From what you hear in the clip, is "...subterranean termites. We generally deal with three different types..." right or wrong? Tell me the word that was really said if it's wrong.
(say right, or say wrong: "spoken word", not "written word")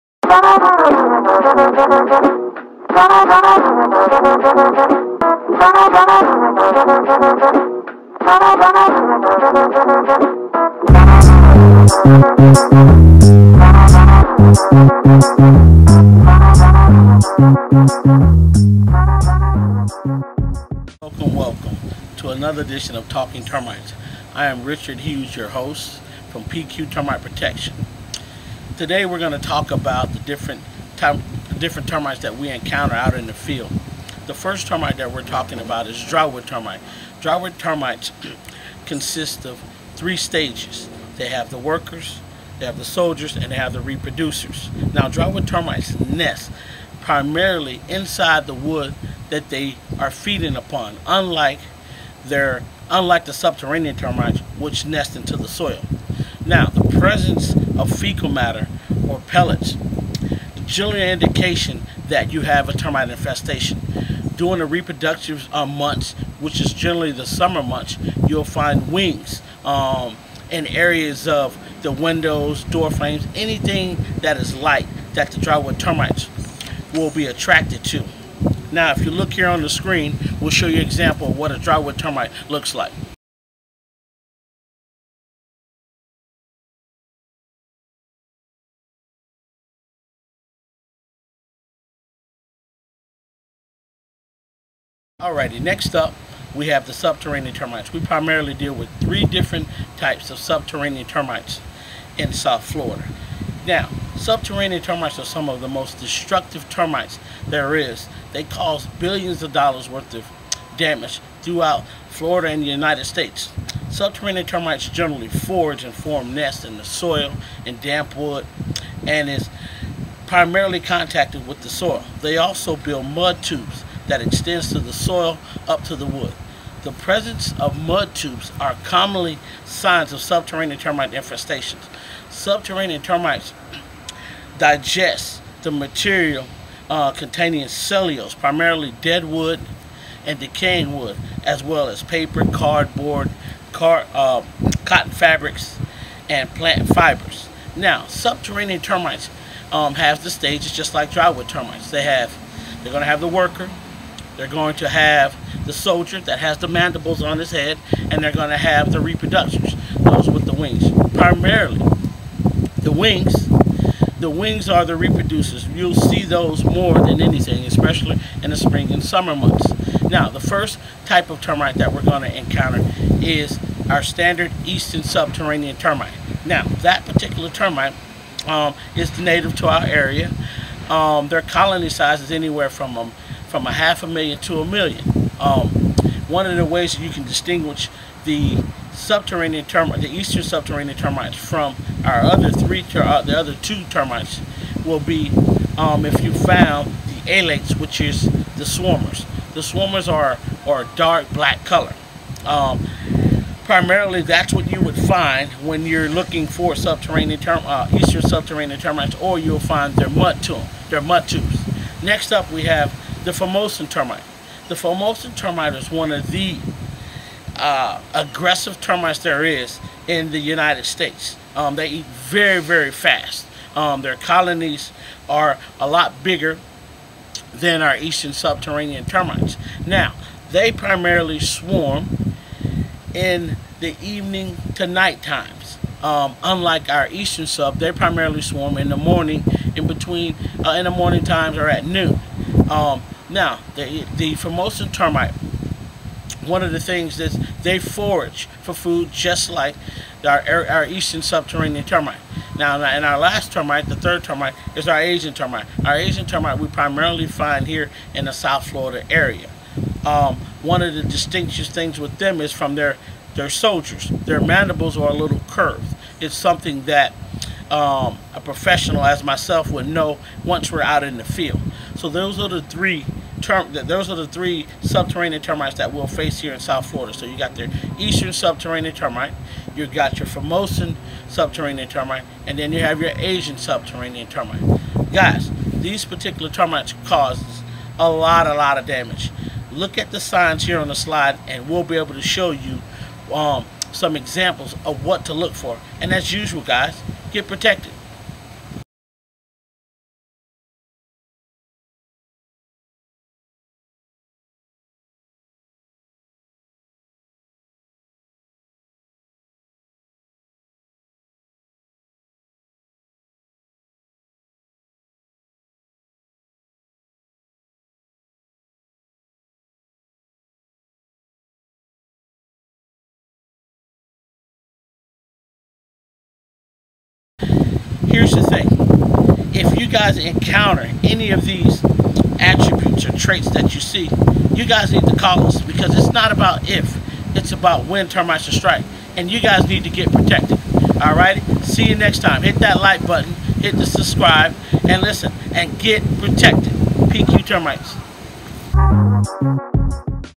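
wrong: "primarily", not "generally".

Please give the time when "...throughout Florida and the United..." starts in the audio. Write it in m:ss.
1:51.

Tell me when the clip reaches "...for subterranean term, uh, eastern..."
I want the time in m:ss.
3:26.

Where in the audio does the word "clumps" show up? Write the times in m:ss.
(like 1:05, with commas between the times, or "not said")
not said.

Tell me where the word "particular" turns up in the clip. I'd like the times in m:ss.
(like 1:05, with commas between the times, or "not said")
2:57, 4:46.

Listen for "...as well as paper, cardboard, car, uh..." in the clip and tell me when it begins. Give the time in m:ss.
2:21.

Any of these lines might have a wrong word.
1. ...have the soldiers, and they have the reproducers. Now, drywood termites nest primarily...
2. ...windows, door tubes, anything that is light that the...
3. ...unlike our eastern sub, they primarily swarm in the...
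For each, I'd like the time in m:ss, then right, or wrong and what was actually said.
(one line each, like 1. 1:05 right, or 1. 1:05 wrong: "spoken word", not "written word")
1. 0:42 right
2. 1:11 wrong: "frames", not "tubes"
3. 3:56 right.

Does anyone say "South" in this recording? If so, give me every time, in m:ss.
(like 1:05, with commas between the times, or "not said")
1:42, 4:18, 4:36.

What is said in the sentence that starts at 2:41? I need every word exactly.
Primarily, the wings, the wings are the reproducers.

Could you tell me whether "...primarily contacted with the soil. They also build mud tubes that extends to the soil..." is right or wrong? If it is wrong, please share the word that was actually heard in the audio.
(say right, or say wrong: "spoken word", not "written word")
right.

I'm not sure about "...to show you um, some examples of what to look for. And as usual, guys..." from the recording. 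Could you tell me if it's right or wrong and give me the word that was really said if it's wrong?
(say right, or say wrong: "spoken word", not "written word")
right.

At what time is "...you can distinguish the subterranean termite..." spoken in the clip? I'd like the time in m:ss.
3:07.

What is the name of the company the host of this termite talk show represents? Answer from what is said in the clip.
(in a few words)
PQ Termite Protection.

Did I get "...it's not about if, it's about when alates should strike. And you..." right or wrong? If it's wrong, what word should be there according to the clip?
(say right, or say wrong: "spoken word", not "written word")
wrong: "termites", not "alates".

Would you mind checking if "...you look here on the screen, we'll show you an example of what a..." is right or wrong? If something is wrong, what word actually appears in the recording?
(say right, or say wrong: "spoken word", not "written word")
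right.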